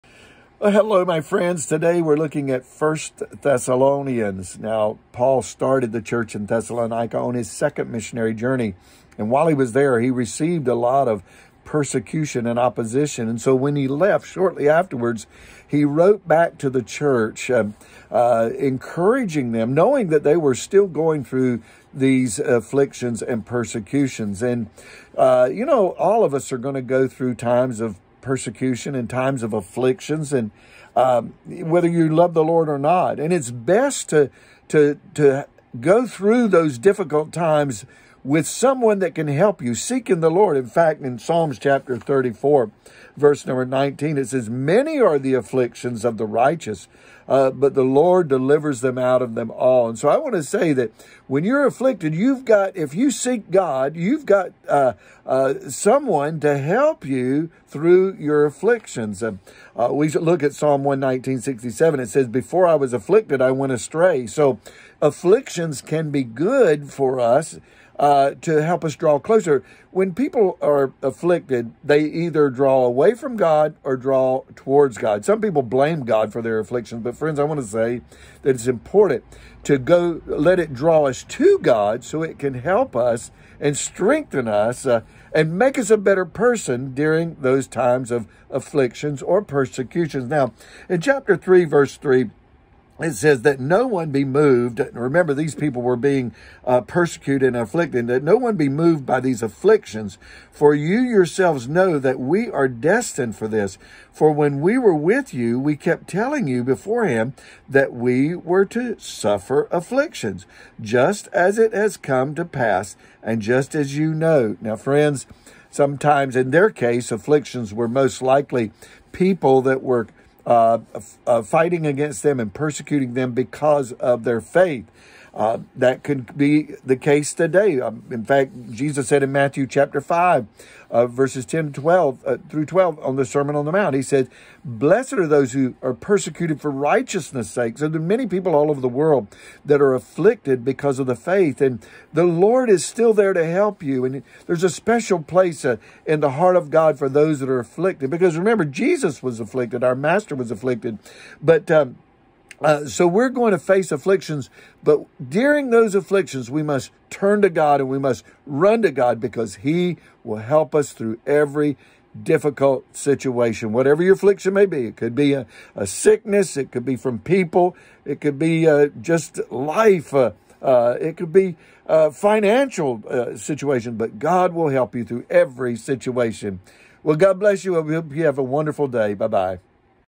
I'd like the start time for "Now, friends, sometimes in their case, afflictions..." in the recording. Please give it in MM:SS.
01:54.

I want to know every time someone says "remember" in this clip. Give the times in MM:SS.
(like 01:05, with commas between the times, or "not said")
01:34, 02:28.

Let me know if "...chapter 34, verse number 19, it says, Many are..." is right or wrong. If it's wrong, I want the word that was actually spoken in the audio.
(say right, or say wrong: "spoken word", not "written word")
right.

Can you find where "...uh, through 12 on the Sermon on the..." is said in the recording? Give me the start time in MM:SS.
02:12.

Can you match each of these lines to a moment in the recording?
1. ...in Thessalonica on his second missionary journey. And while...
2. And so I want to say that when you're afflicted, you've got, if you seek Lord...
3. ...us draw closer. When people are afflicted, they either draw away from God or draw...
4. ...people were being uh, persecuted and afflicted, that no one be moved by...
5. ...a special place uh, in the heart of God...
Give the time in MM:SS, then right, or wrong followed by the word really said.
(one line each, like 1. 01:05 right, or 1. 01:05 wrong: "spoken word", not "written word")
1. 00:06 right
2. 00:49 wrong: "God", not "Lord"
3. 01:08 right
4. 01:35 right
5. 02:24 right.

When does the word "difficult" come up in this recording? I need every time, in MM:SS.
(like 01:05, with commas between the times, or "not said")
00:36, 02:42.